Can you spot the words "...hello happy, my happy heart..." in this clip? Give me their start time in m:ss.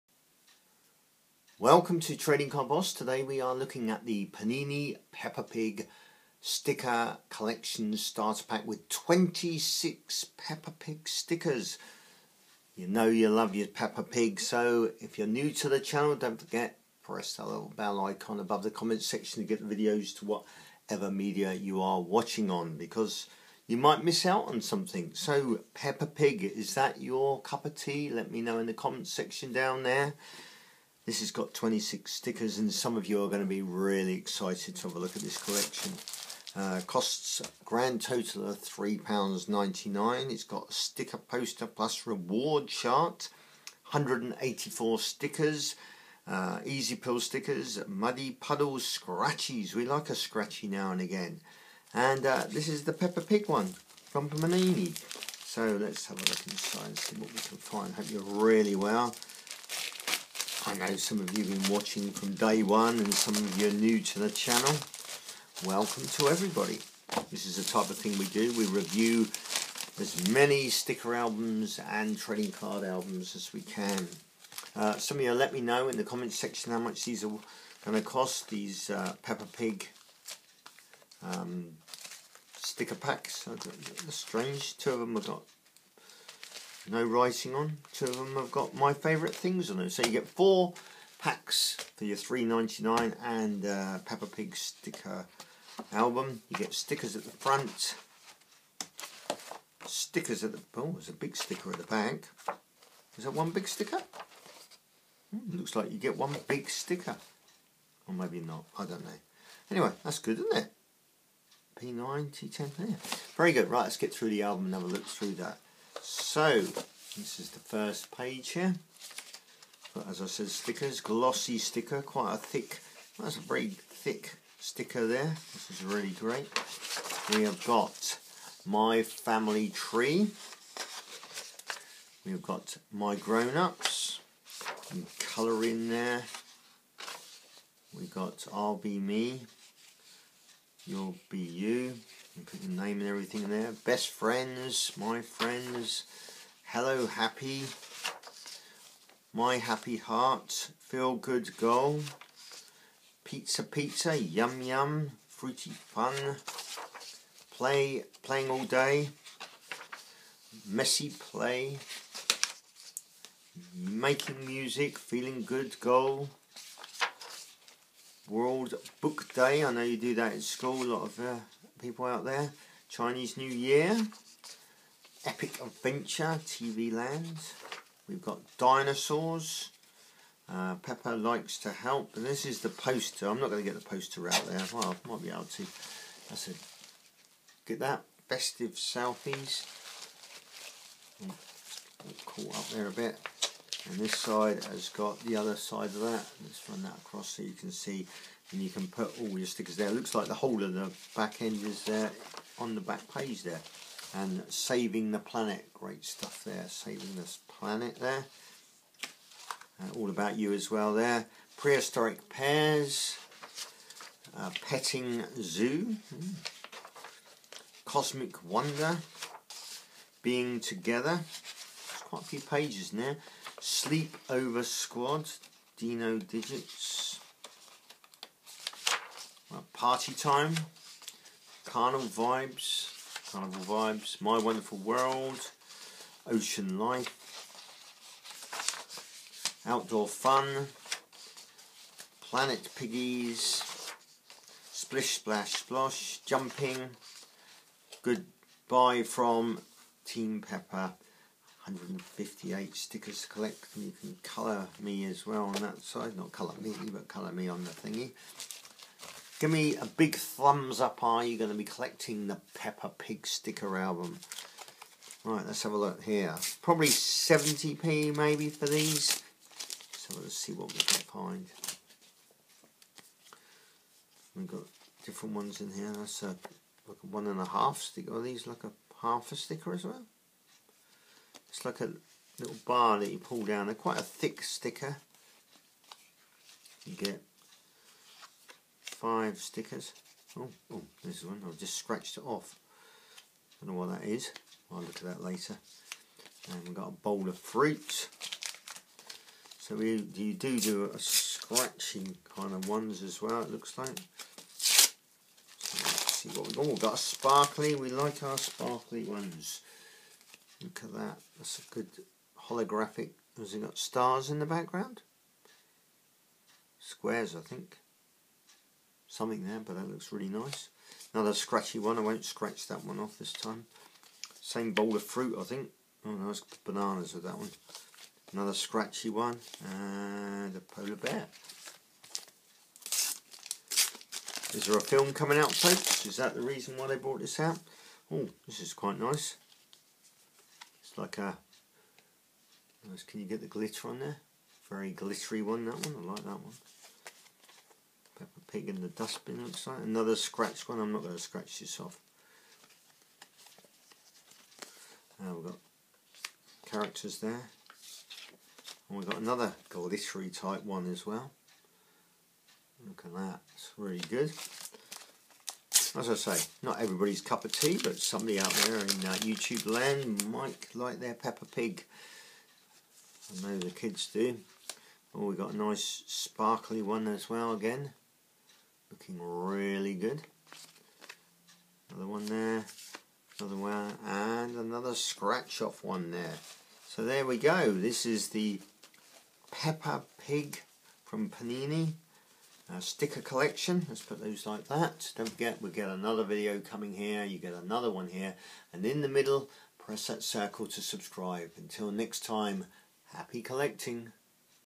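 2:26.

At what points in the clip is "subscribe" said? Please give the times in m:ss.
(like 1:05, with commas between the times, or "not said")
6:40.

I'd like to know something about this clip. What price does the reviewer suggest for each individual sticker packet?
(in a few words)
70p.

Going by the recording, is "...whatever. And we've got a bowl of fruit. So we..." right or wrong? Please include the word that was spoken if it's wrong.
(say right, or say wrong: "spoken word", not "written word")
wrong: "later", not "whatever".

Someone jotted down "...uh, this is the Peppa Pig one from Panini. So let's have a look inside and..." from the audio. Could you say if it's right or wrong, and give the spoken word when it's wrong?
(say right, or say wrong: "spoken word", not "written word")
right.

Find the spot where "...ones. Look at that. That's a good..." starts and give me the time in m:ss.
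5:09.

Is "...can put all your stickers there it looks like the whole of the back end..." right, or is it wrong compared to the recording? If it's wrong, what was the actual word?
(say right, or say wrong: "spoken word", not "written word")
right.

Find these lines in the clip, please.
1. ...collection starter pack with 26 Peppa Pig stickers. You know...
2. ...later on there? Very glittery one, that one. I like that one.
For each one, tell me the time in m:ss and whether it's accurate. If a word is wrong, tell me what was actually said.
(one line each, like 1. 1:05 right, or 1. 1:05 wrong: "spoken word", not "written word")
1. 0:07 right
2. 5:43 wrong: "glitter", not "later".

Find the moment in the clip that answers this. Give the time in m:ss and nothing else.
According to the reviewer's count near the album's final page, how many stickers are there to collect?
4:11.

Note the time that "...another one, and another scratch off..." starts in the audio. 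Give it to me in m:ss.
6:23.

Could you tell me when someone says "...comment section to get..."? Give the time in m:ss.
0:18.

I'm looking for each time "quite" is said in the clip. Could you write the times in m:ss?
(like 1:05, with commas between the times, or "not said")
2:02, 3:42, 4:43, 5:38.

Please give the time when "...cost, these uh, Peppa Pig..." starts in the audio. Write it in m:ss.
1:18.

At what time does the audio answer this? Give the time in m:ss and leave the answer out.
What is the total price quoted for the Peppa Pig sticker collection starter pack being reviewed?
0:38.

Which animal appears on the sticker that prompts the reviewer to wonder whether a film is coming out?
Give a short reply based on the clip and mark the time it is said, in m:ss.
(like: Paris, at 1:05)
Polar bear, at 5:30.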